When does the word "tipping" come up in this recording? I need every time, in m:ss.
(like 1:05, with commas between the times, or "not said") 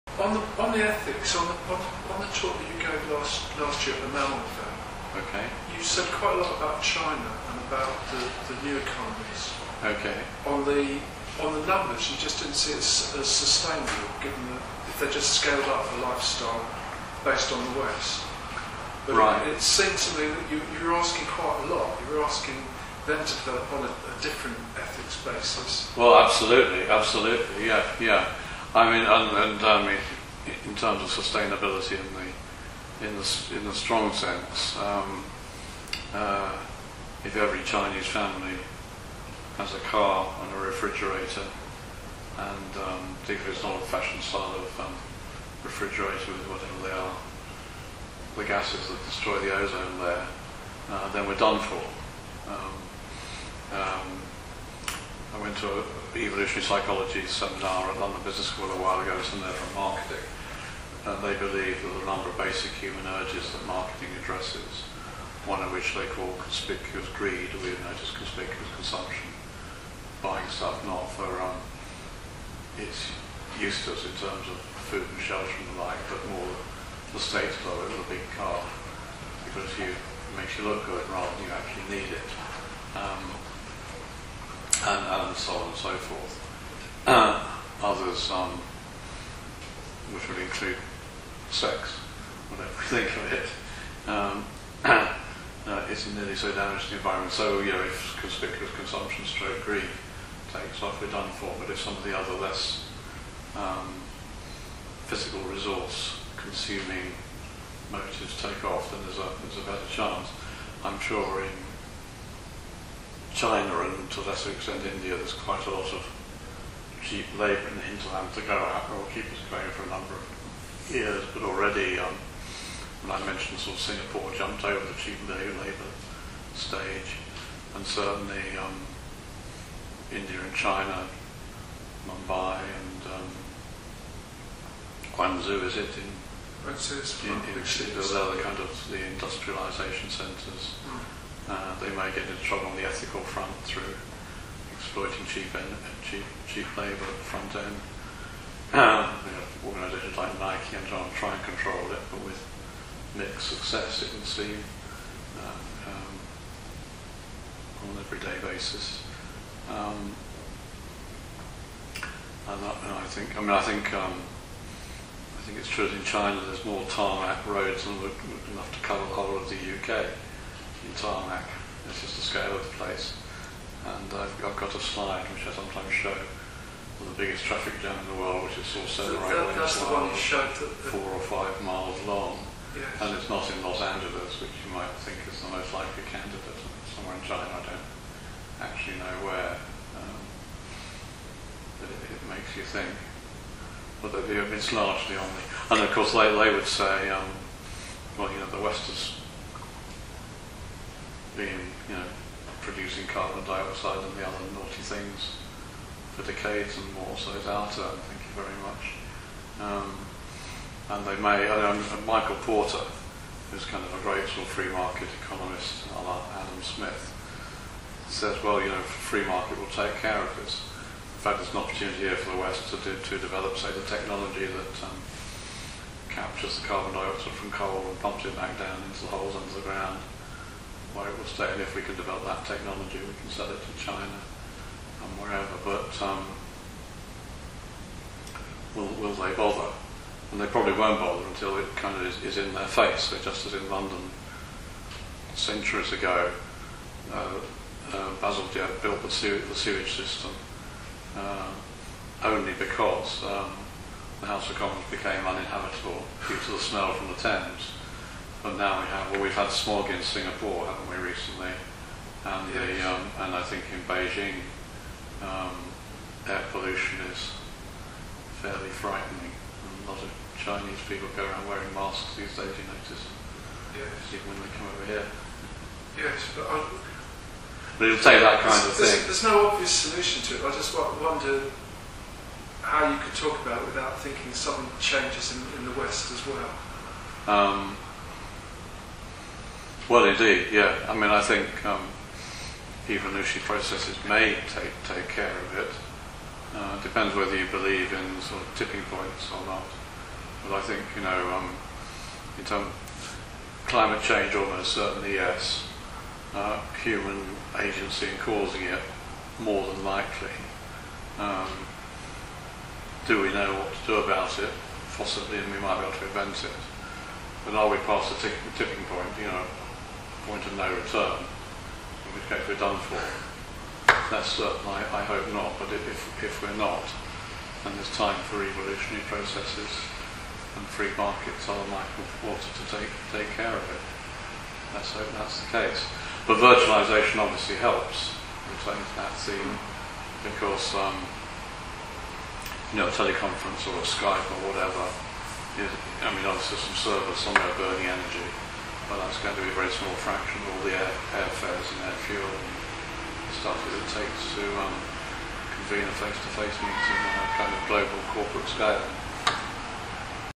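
4:58, 5:18.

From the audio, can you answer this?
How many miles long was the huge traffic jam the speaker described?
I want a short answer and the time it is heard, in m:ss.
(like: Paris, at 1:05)
4 or 5 miles, at 3:00.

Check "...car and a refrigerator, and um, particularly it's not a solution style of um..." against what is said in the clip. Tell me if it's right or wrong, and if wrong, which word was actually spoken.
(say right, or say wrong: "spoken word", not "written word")
wrong: "fashion", not "solution".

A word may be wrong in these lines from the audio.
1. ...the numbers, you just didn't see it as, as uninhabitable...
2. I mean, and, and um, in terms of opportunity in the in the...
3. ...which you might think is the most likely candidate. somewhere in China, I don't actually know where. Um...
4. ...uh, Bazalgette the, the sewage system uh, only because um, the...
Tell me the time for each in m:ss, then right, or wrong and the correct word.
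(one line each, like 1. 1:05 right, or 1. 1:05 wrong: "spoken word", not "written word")
1. 0:11 wrong: "sustainable", not "uninhabitable"
2. 0:28 wrong: "sustainability", not "opportunity"
3. 3:04 right
4. 4:07 right.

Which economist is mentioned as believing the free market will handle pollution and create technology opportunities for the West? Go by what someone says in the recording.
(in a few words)
Michael Porter.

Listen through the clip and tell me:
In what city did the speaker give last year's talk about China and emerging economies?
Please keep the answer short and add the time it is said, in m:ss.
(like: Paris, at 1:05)
Melbourne, at 0:04.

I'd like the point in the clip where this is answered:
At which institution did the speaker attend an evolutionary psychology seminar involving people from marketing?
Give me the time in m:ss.
0:58.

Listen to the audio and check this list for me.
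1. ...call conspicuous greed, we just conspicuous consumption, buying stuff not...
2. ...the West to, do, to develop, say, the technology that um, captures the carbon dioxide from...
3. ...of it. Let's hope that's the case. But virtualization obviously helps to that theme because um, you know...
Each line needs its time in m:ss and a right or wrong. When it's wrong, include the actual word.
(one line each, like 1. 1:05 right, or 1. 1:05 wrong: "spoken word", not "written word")
1. 1:06 right
2. 3:42 right
3. 5:33 right.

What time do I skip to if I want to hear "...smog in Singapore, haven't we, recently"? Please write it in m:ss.
4:19.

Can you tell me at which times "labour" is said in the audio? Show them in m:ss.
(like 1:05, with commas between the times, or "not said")
1:57, 2:05, 2:26.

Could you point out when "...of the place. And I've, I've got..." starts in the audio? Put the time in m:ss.
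2:52.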